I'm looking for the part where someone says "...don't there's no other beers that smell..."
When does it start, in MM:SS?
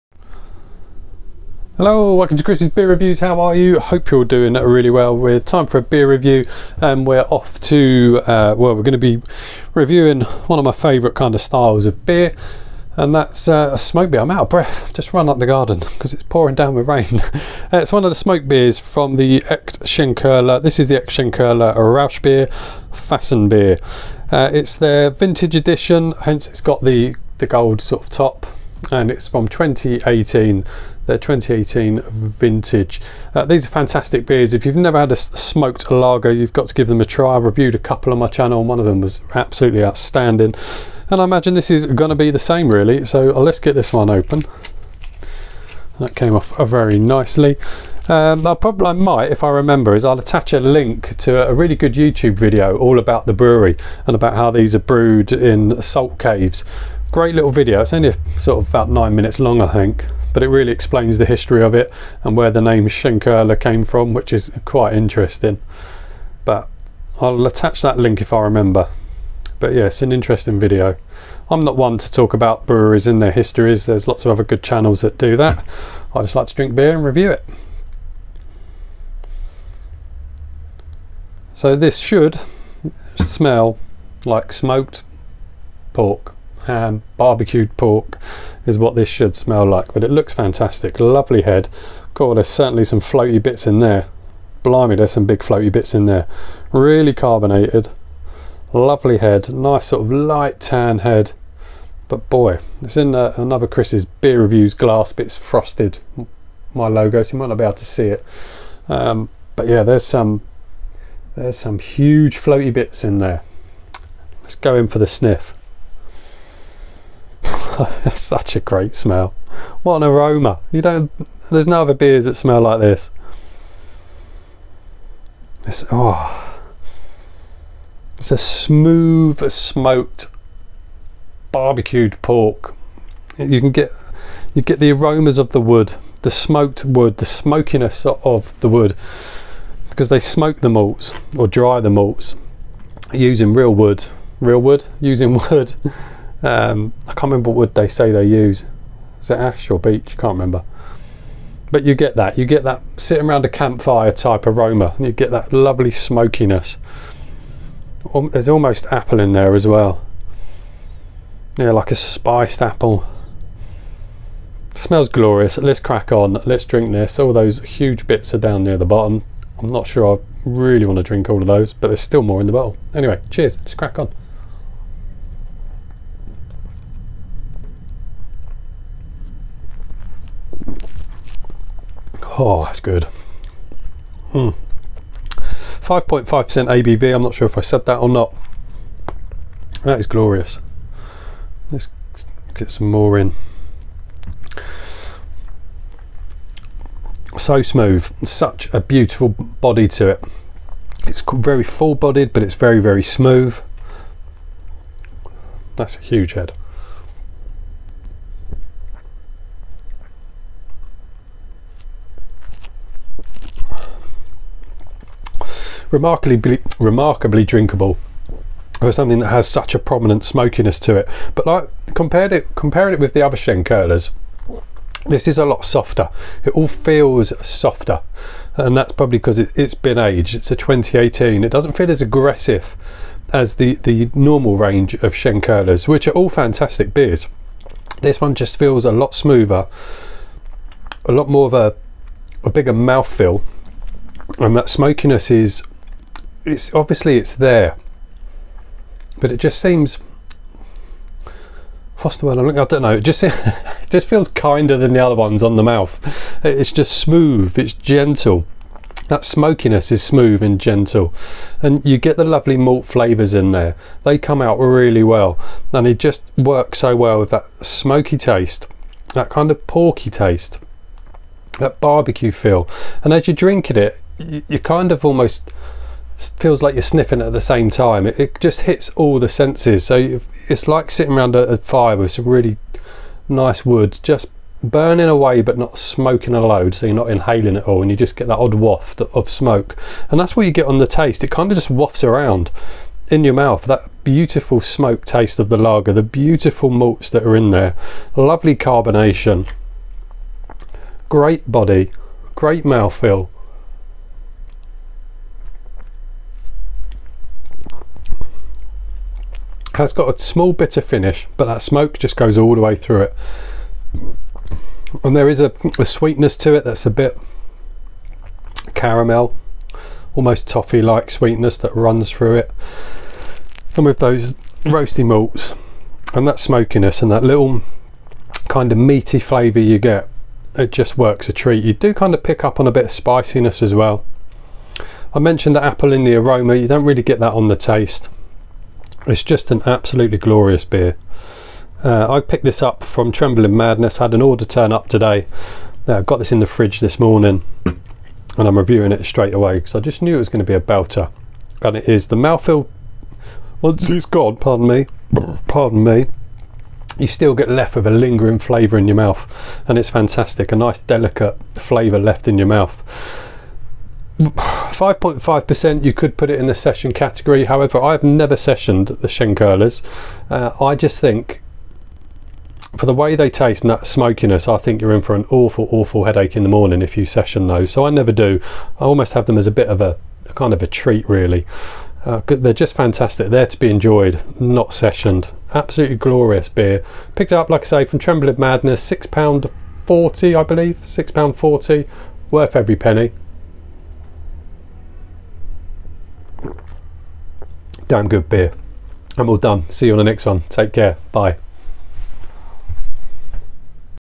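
02:00.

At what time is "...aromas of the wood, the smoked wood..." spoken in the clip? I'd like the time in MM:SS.
02:14.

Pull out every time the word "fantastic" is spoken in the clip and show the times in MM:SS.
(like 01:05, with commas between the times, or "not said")
00:33, 01:30, 03:56, 05:59, 06:22.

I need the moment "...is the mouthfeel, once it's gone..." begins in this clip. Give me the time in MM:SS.
05:51.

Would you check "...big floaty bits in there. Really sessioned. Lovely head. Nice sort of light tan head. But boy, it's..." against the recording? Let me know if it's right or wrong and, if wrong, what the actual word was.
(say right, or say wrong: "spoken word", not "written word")
wrong: "carbonated", not "sessioned".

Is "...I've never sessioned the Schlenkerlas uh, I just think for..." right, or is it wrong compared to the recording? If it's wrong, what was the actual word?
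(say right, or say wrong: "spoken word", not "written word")
right.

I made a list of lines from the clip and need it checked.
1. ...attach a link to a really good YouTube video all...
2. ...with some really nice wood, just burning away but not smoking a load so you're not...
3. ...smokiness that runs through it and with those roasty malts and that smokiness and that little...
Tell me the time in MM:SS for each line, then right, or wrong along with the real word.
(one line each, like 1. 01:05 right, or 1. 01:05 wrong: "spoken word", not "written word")
1. 00:50 right
2. 04:41 right
3. 05:21 wrong: "sweetness", not "smokiness".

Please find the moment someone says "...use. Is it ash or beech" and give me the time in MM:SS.
02:28.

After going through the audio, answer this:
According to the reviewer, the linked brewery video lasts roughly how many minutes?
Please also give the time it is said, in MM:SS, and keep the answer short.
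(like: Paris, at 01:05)
nine minutes, at 00:58.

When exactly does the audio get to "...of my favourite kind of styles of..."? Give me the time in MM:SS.
00:10.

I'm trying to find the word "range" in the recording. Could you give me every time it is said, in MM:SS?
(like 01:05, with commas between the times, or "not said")
03:54.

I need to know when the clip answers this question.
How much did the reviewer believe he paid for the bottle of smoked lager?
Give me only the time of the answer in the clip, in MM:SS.
06:30.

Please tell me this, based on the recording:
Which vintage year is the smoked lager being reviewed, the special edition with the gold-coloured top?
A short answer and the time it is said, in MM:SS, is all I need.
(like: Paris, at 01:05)
2018, at 00:29.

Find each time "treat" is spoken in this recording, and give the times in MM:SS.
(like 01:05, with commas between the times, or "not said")
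05:31, 06:20.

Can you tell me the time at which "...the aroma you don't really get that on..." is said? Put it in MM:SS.
05:36.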